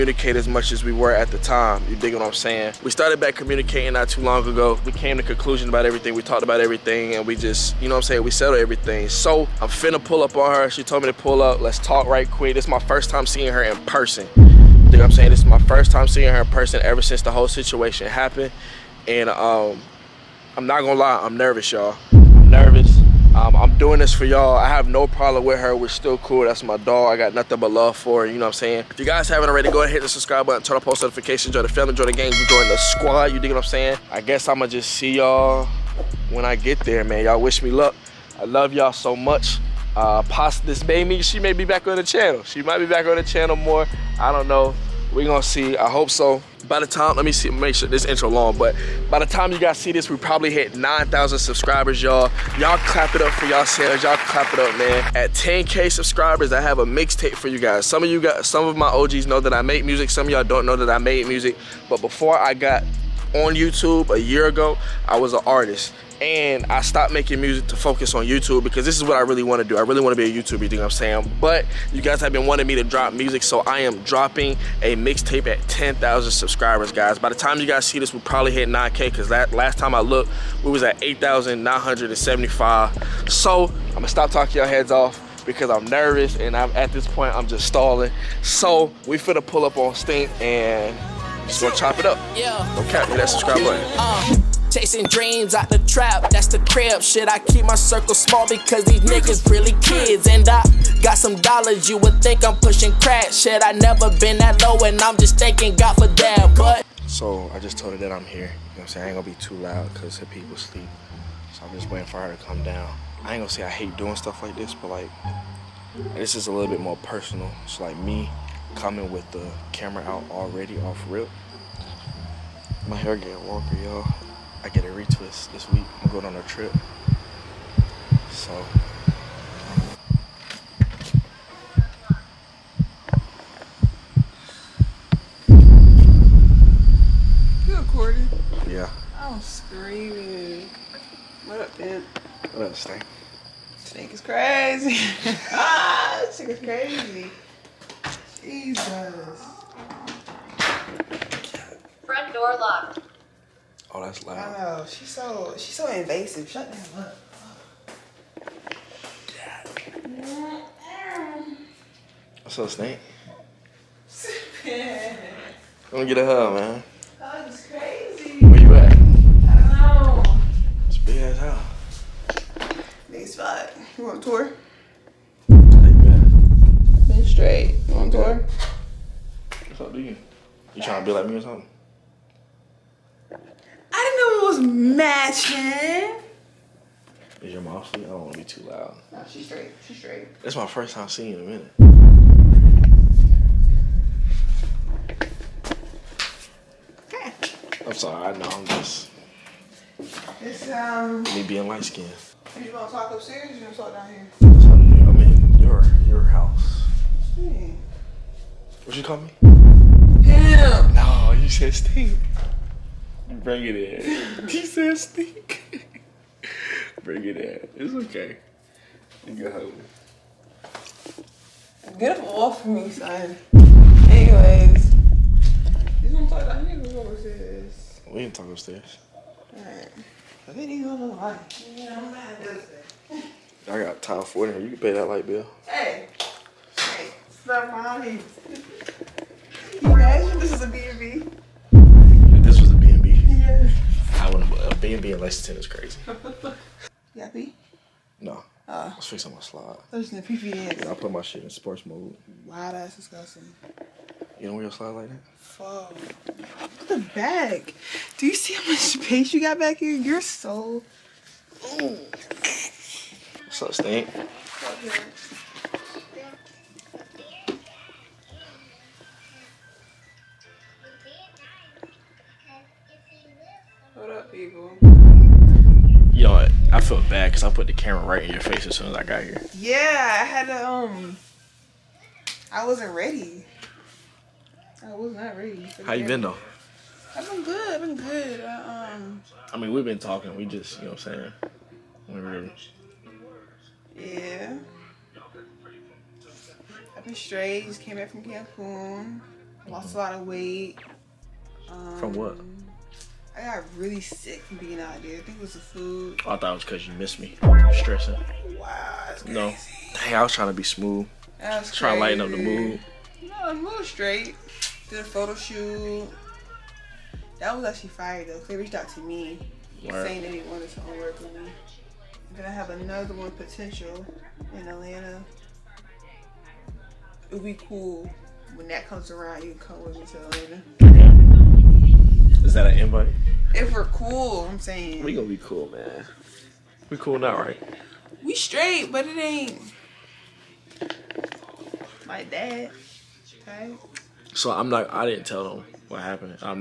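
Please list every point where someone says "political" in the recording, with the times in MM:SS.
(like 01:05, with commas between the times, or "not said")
not said.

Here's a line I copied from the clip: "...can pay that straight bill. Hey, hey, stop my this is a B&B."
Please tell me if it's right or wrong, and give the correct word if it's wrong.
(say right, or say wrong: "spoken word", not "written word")
wrong: "light", not "straight".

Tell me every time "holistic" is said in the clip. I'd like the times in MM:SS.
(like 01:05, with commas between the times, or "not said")
not said.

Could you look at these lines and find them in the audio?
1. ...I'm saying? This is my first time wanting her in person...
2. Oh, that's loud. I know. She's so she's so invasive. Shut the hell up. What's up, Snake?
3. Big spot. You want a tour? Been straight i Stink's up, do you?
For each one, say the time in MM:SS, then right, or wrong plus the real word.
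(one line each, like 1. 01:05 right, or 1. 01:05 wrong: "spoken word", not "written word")
1. 00:15 wrong: "seeing", not "wanting"
2. 02:33 right
3. 02:53 wrong: "What", not "Stink".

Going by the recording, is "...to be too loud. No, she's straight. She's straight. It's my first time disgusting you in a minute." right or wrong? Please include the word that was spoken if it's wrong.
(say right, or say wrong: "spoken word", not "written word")
wrong: "seeing", not "disgusting".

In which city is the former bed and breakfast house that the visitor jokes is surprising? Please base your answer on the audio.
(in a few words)
Lexington.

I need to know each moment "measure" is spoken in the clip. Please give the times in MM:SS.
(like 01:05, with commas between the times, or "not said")
not said.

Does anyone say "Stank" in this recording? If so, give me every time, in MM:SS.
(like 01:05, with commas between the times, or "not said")
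02:22.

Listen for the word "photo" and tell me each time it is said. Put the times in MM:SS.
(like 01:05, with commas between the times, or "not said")
05:15.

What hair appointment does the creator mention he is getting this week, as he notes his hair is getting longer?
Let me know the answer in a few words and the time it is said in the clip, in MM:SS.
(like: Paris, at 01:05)
A retwist, at 02:04.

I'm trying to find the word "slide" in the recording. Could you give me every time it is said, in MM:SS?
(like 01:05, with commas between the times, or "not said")
04:09, 04:14.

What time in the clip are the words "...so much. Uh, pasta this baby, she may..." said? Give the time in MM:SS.
00:38.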